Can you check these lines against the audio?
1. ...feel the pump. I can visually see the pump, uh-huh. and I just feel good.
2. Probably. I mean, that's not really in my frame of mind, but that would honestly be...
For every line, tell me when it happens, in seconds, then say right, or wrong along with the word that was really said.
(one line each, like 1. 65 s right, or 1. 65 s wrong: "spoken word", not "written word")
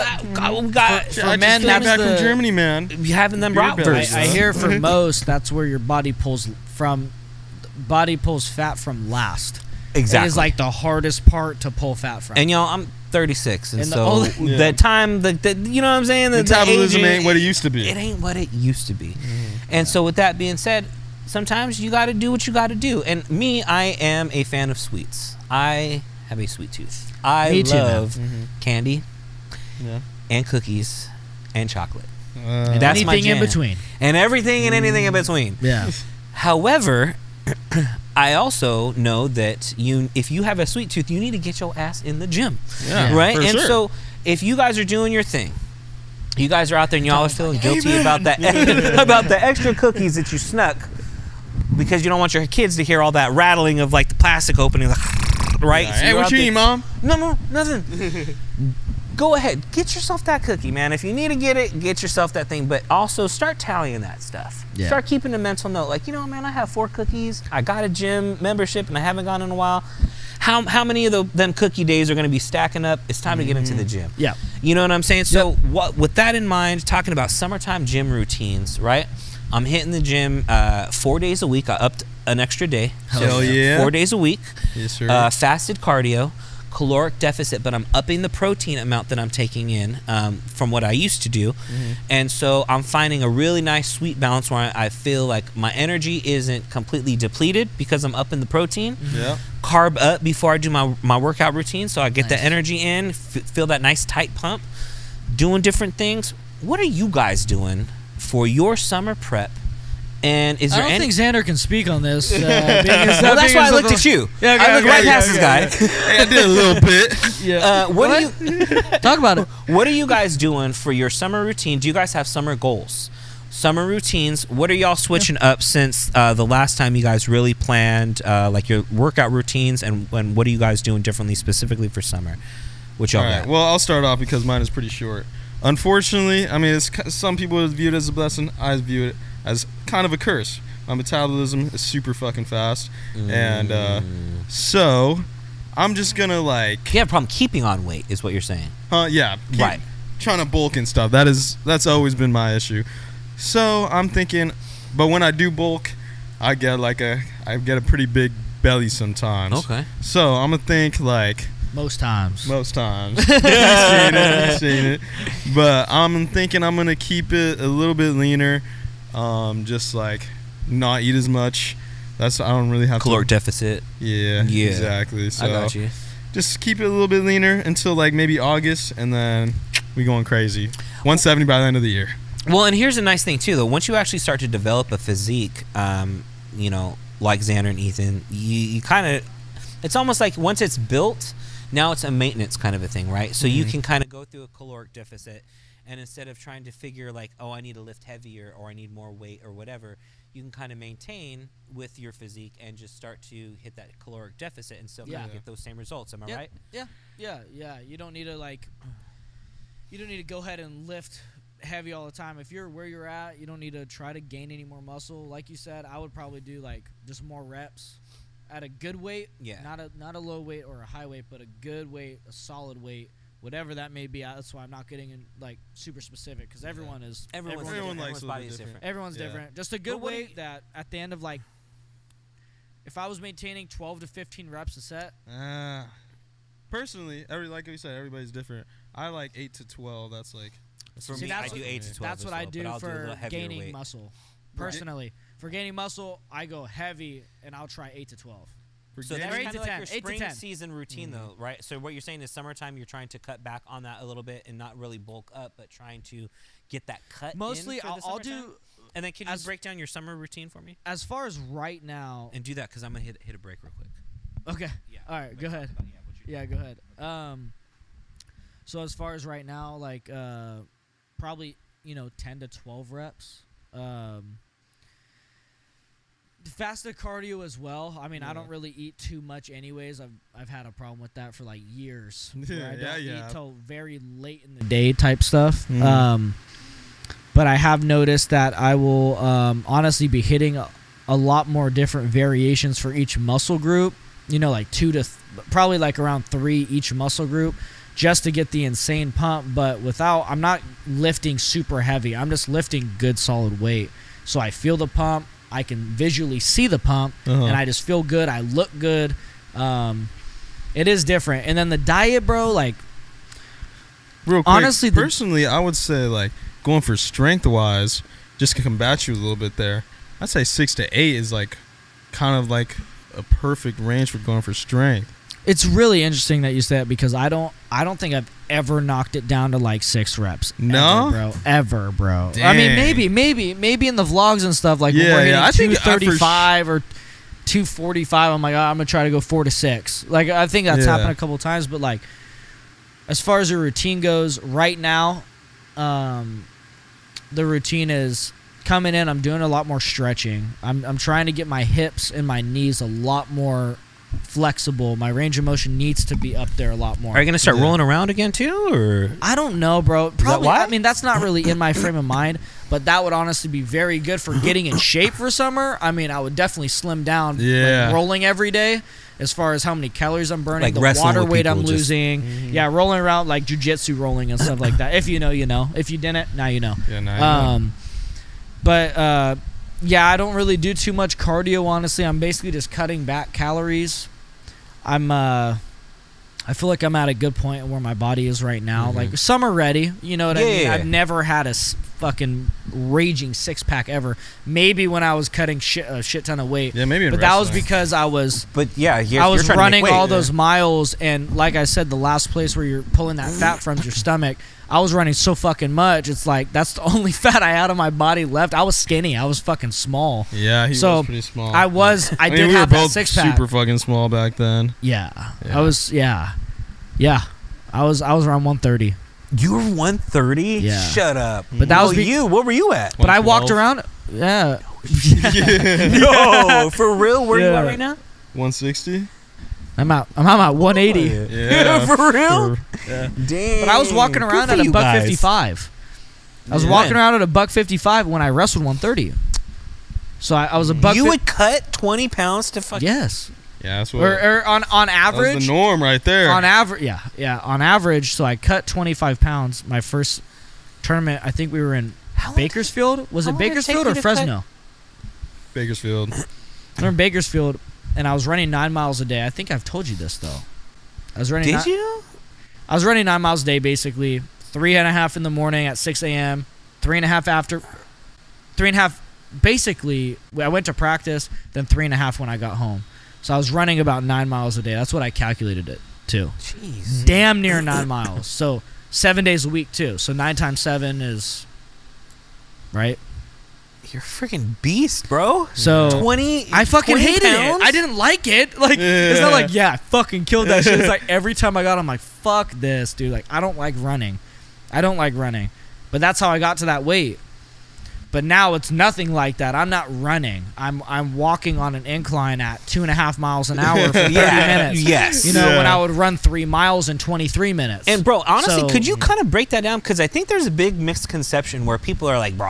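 1. 304 s right
2. 360 s right.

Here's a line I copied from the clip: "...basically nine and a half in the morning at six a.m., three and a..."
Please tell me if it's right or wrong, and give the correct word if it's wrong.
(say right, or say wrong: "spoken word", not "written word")
wrong: "three", not "nine".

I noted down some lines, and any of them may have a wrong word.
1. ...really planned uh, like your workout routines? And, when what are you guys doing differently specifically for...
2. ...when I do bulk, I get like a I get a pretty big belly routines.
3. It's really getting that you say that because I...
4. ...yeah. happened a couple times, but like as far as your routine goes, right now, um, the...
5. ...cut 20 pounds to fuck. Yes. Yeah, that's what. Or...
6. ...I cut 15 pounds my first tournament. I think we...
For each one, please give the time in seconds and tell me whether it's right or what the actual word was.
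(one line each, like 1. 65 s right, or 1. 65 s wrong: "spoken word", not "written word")
1. 127 s right
2. 155 s wrong: "sometimes", not "routines"
3. 325 s wrong: "interesting", not "getting"
4. 340 s right
5. 441 s right
6. 448 s wrong: "25", not "15".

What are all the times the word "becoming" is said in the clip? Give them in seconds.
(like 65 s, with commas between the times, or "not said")
not said.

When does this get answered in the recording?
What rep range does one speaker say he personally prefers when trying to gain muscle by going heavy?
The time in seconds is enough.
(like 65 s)
239 s.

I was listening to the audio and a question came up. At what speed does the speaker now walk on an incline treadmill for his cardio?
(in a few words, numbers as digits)
2.5 miles an hour.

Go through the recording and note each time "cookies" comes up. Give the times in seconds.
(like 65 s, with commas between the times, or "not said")
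30 s, 49 s, 60 s, 66 s, 71 s.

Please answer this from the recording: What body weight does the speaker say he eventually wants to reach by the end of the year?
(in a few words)
170.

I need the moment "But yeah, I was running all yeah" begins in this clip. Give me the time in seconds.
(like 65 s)
398 s.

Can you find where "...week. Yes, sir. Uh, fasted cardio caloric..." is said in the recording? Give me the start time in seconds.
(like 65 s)
84 s.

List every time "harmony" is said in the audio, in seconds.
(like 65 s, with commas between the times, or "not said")
not said.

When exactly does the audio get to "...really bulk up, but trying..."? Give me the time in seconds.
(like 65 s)
254 s.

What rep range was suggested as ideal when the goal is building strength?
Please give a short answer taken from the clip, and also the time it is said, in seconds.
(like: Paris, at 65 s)
6 to 8, at 320 s.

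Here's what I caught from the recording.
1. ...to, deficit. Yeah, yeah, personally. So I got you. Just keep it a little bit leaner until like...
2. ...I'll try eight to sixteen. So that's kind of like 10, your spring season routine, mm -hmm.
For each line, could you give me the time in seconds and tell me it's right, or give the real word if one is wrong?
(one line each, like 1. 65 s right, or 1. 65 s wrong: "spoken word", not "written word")
1. 173 s wrong: "exactly", not "personally"
2. 247 s wrong: "twelve", not "sixteen".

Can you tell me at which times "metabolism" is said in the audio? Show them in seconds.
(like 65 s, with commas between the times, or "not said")
16 s, 140 s.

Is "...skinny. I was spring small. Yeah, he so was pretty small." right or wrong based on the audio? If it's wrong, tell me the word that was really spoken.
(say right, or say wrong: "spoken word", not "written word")
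wrong: "fucking", not "spring".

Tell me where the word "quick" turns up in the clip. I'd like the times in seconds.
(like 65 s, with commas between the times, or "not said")
263 s, 314 s.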